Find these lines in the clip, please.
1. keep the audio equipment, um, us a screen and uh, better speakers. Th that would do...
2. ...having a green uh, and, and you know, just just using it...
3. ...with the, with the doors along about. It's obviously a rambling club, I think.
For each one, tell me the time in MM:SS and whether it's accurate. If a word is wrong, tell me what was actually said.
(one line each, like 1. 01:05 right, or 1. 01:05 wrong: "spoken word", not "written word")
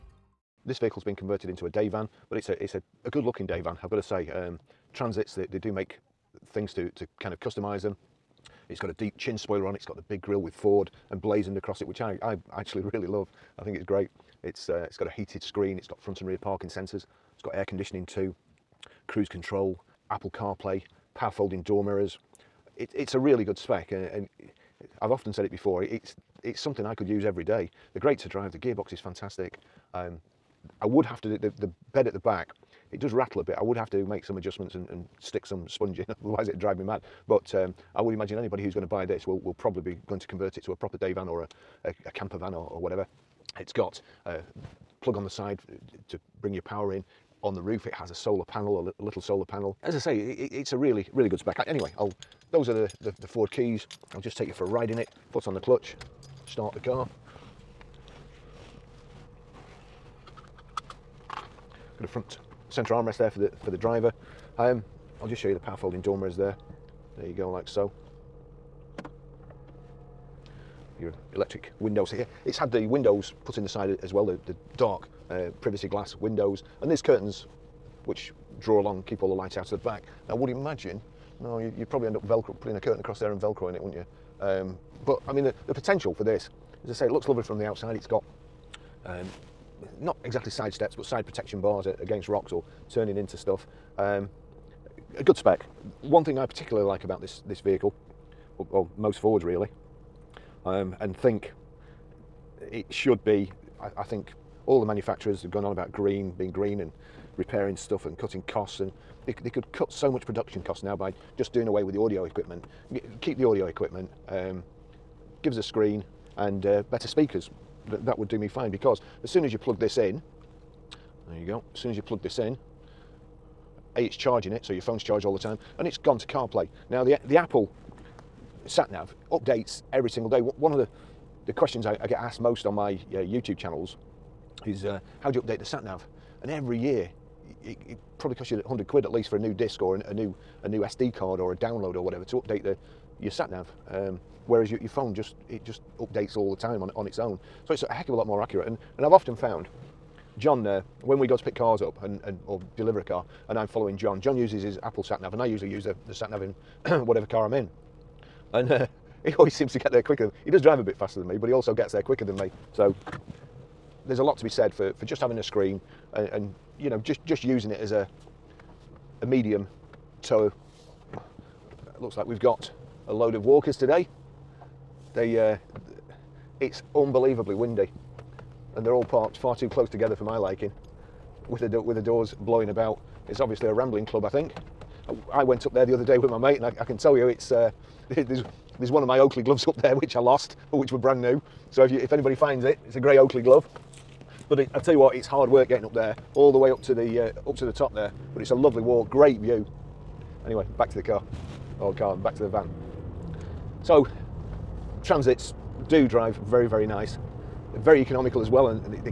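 1. 01:53 right
2. 02:45 wrong: "screen", not "green"
3. 03:01 wrong: "blowing", not "along".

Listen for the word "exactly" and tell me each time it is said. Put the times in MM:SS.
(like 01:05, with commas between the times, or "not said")
01:30.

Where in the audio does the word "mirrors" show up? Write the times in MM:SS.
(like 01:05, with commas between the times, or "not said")
00:21, 01:06.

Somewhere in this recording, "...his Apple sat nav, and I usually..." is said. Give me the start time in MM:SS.
02:34.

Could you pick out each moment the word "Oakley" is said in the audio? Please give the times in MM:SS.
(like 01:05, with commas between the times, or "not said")
03:09, 03:13.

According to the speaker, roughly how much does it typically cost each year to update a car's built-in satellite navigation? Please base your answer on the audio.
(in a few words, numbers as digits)
100 quid.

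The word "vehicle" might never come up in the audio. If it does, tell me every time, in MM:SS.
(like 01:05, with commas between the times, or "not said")
00:00, 01:37.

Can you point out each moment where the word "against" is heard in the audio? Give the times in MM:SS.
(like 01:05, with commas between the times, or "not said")
01:31.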